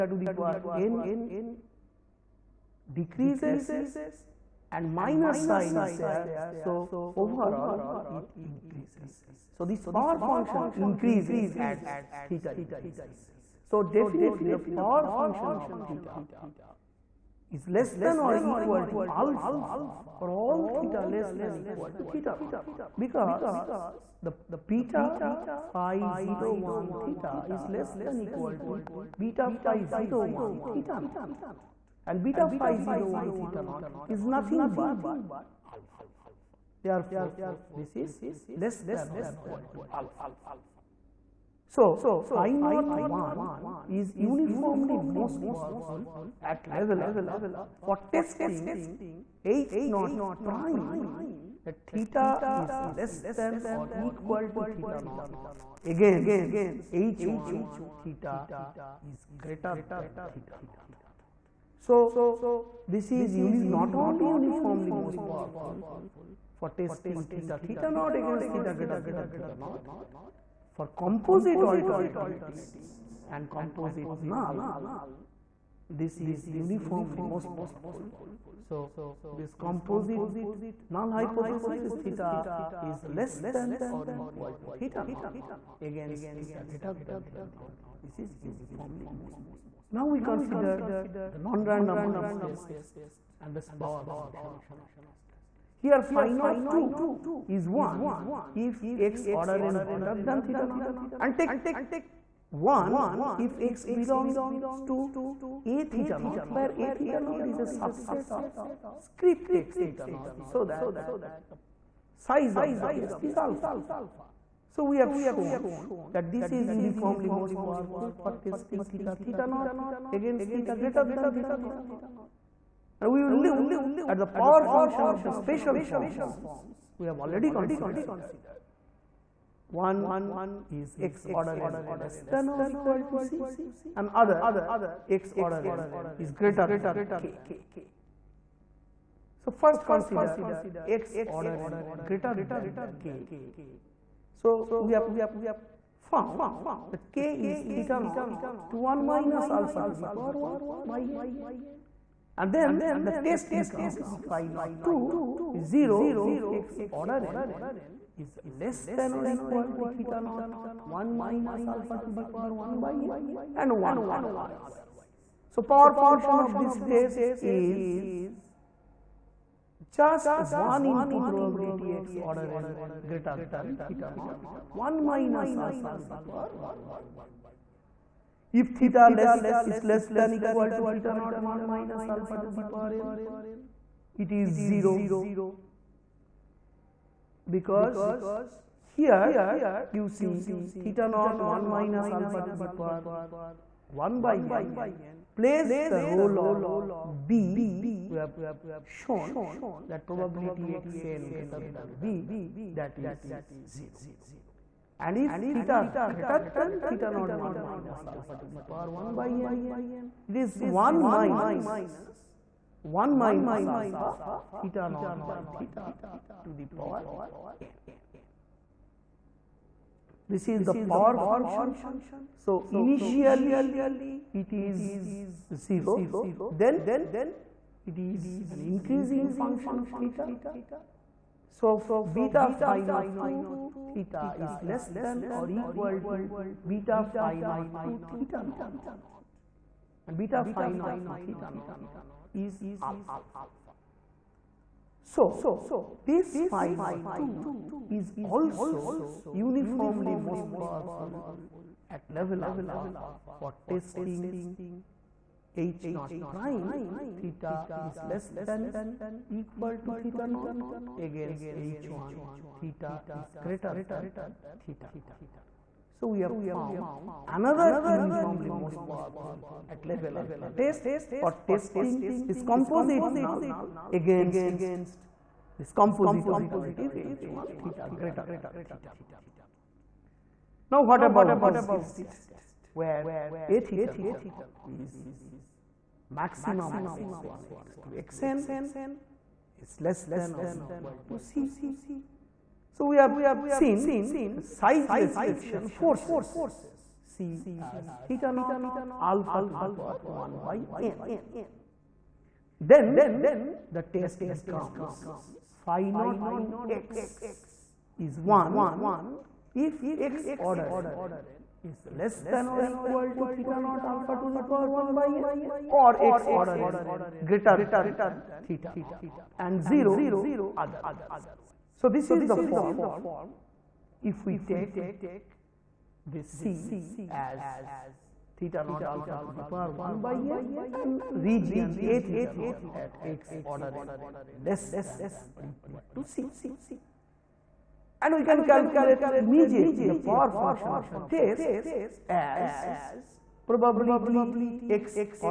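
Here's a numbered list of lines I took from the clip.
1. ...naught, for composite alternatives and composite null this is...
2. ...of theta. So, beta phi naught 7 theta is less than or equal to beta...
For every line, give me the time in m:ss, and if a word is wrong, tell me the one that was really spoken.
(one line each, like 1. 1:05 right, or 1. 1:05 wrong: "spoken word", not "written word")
1. 1:09 right
2. 3:49 wrong: "2", not "7".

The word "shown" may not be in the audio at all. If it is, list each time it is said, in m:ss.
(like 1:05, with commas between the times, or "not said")
1:55, 3:19.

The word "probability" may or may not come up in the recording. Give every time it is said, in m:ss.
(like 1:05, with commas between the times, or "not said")
2:51, 3:20, 5:43.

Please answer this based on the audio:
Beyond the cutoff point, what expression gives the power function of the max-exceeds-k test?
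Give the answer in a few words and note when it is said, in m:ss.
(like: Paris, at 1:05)
1 - (1 - alpha)(theta naught/theta)^n, at 3:30.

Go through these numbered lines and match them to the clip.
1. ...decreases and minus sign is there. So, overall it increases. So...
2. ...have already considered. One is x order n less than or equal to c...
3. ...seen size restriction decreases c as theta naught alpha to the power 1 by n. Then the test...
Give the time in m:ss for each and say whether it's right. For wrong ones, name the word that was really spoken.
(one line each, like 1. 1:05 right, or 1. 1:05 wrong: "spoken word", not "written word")
1. 0:02 right
2. 2:07 right
3. 4:53 wrong: "forces", not "decreases".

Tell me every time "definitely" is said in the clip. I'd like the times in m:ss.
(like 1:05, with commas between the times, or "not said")
0:13.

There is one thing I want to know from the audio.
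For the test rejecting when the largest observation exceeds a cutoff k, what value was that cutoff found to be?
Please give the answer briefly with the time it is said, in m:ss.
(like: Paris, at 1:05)
theta naught (1 - alpha)^(1/n), at 2:27.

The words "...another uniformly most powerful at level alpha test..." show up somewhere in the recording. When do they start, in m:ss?
4:27.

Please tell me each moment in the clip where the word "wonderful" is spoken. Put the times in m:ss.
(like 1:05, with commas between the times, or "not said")
not said.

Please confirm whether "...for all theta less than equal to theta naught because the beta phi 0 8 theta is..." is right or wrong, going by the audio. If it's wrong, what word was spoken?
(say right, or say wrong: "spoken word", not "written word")
wrong: "1", not "8".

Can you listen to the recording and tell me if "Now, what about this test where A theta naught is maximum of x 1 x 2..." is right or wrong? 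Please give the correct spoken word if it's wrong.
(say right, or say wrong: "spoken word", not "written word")
right.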